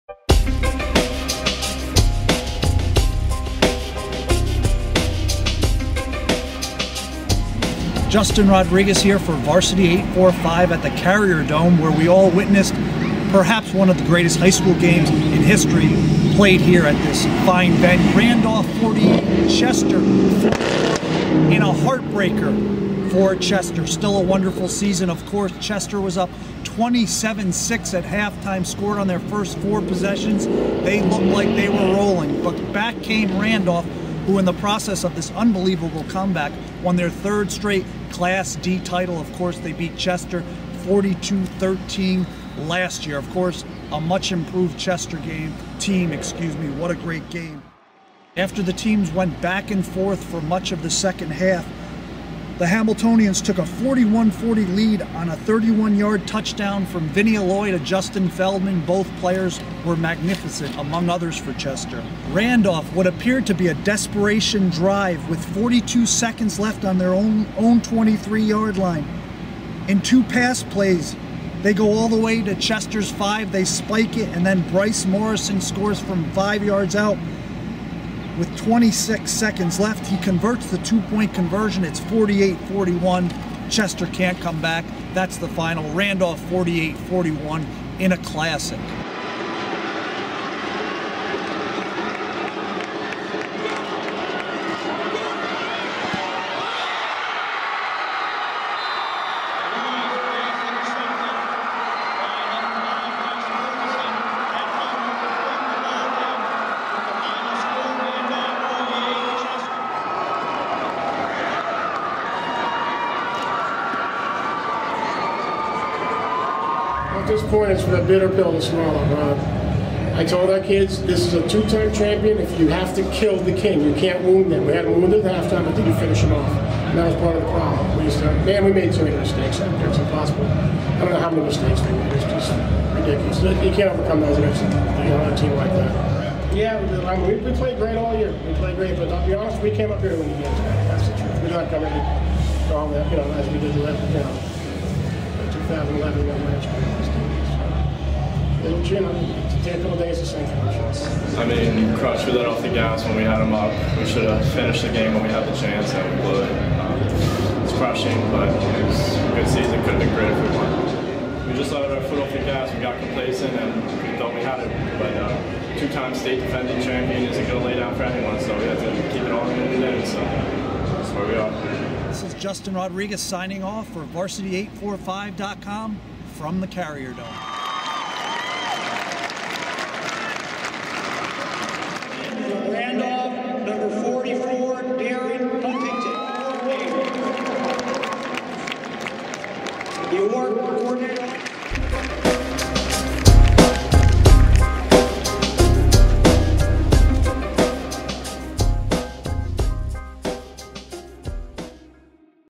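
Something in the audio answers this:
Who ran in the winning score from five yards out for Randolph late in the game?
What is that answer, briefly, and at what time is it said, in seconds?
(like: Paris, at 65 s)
Bryce Morrison, at 74 s.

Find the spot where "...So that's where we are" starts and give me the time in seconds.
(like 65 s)
170 s.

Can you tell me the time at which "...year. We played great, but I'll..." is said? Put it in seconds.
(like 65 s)
138 s.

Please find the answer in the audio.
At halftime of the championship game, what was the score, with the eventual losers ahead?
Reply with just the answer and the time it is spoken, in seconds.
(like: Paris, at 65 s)
27-6, at 26 s.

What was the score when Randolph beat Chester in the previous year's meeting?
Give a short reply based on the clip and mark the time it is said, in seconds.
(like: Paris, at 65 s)
42-13, at 40 s.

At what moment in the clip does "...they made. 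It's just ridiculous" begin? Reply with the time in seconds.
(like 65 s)
131 s.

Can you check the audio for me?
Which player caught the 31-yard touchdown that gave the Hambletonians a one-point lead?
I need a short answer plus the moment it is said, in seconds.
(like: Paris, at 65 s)
Justin Feldman, at 57 s.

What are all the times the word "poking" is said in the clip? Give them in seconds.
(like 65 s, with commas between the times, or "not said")
not said.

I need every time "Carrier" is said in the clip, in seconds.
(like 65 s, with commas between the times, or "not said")
11 s, 176 s.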